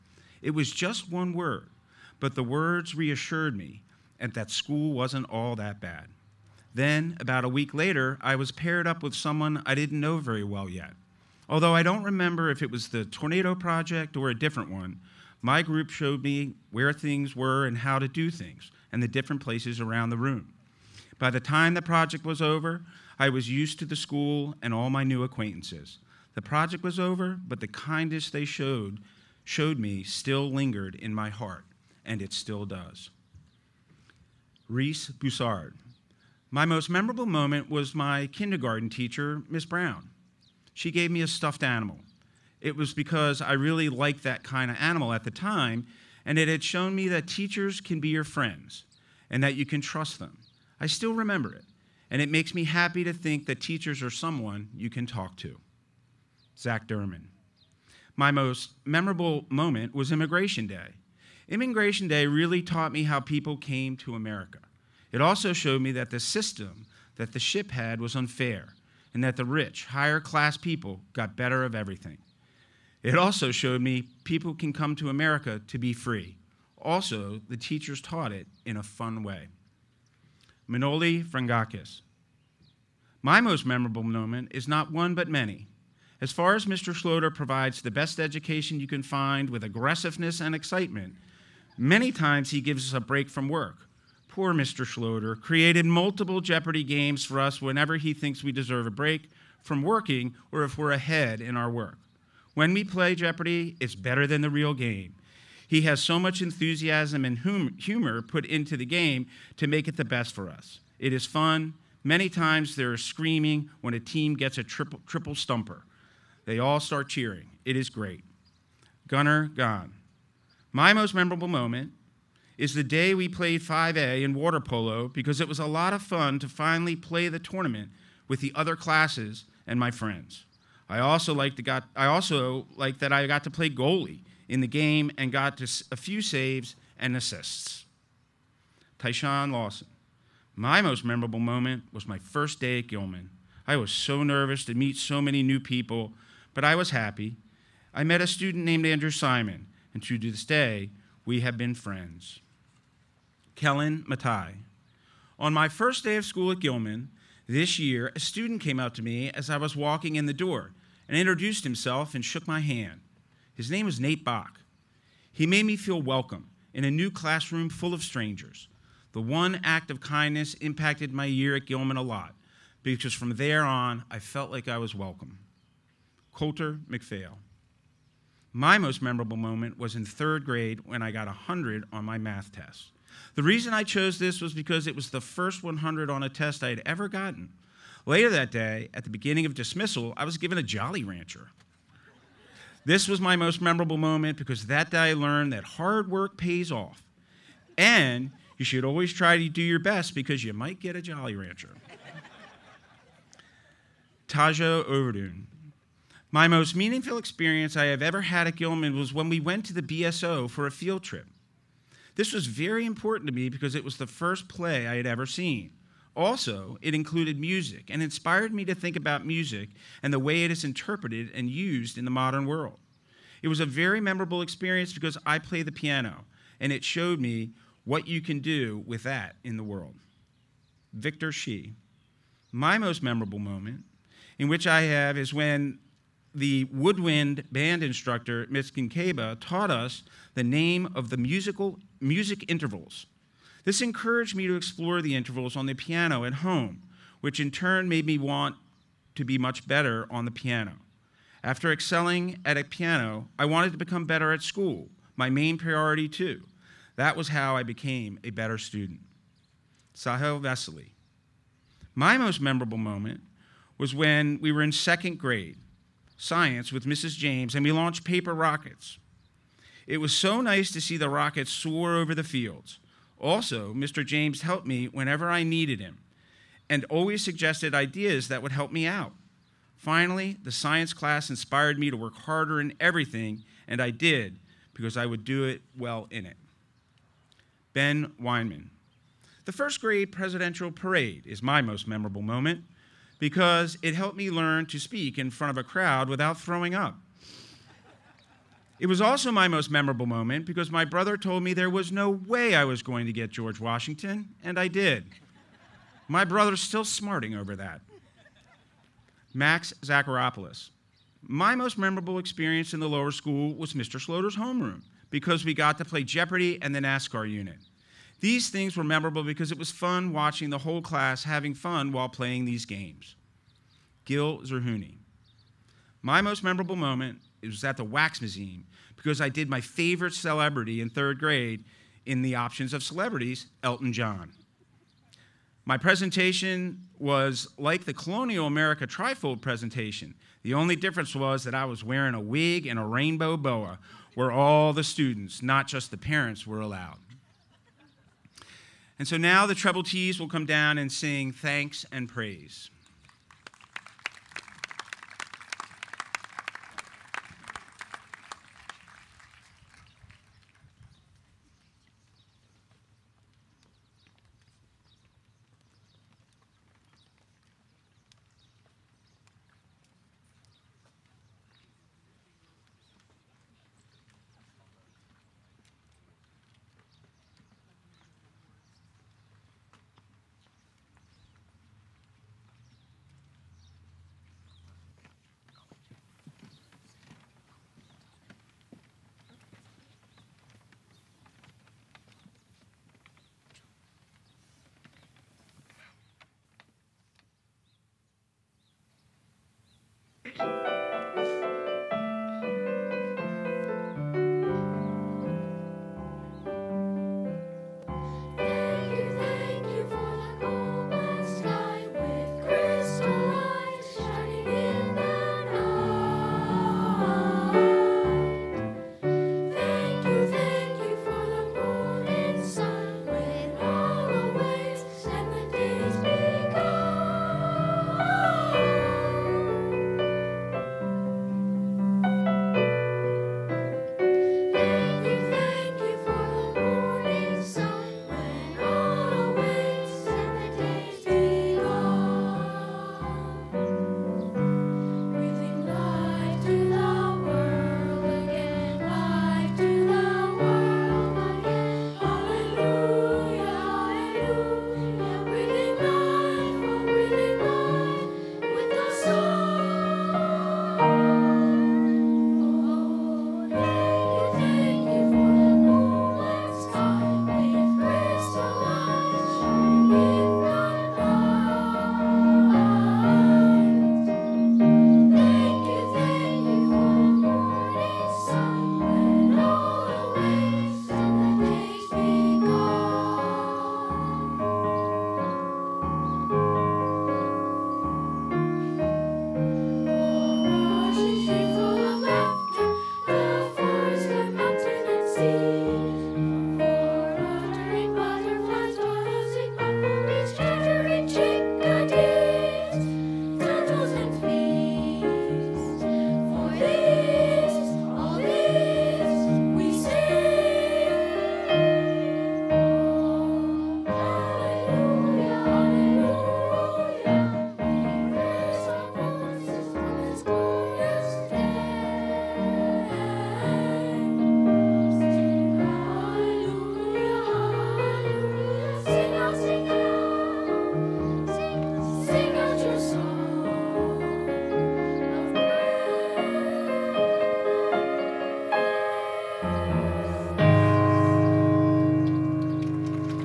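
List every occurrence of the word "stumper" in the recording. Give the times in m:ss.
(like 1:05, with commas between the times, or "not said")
1:55.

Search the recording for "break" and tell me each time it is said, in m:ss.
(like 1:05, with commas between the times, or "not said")
1:33, 1:38.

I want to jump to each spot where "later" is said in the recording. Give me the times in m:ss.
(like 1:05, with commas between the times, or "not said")
0:07, 3:08.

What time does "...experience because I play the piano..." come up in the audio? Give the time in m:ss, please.
3:44.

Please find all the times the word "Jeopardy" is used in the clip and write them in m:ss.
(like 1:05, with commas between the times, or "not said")
1:36, 1:43, 5:16.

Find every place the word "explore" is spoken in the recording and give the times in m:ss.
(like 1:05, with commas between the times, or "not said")
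4:04.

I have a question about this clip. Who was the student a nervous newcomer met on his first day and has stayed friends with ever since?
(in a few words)
Andrew Simon.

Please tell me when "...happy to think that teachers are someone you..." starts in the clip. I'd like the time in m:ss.
0:52.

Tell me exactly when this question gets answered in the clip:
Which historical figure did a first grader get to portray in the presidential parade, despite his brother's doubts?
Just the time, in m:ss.
5:03.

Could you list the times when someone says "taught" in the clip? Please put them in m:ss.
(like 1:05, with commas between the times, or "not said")
1:02, 1:18, 3:59.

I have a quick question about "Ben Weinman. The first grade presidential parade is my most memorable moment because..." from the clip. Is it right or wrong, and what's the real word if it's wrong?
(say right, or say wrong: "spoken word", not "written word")
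right.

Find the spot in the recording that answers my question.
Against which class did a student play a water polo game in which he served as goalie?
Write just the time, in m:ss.
2:03.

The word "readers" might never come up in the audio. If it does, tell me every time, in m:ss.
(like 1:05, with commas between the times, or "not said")
not said.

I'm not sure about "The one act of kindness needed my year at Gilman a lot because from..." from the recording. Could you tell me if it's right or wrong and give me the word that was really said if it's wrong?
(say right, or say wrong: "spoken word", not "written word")
wrong: "impacted", not "needed".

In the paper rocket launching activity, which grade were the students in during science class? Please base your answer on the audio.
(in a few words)
Second grade.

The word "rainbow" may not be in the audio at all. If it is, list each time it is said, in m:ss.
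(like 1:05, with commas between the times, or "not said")
5:42.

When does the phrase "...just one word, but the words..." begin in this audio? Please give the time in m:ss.
0:00.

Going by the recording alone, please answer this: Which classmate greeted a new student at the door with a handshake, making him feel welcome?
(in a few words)
Nate Bach.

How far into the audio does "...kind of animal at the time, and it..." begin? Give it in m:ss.
0:44.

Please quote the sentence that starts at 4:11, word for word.
After excelling at a piano, I wanted to become better at school, my main priority too.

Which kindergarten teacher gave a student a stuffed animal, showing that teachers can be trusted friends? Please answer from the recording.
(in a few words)
Miss Brown.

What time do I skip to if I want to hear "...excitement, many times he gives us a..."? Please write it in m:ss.
1:30.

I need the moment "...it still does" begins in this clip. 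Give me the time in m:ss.
0:32.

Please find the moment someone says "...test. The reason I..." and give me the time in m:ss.
3:02.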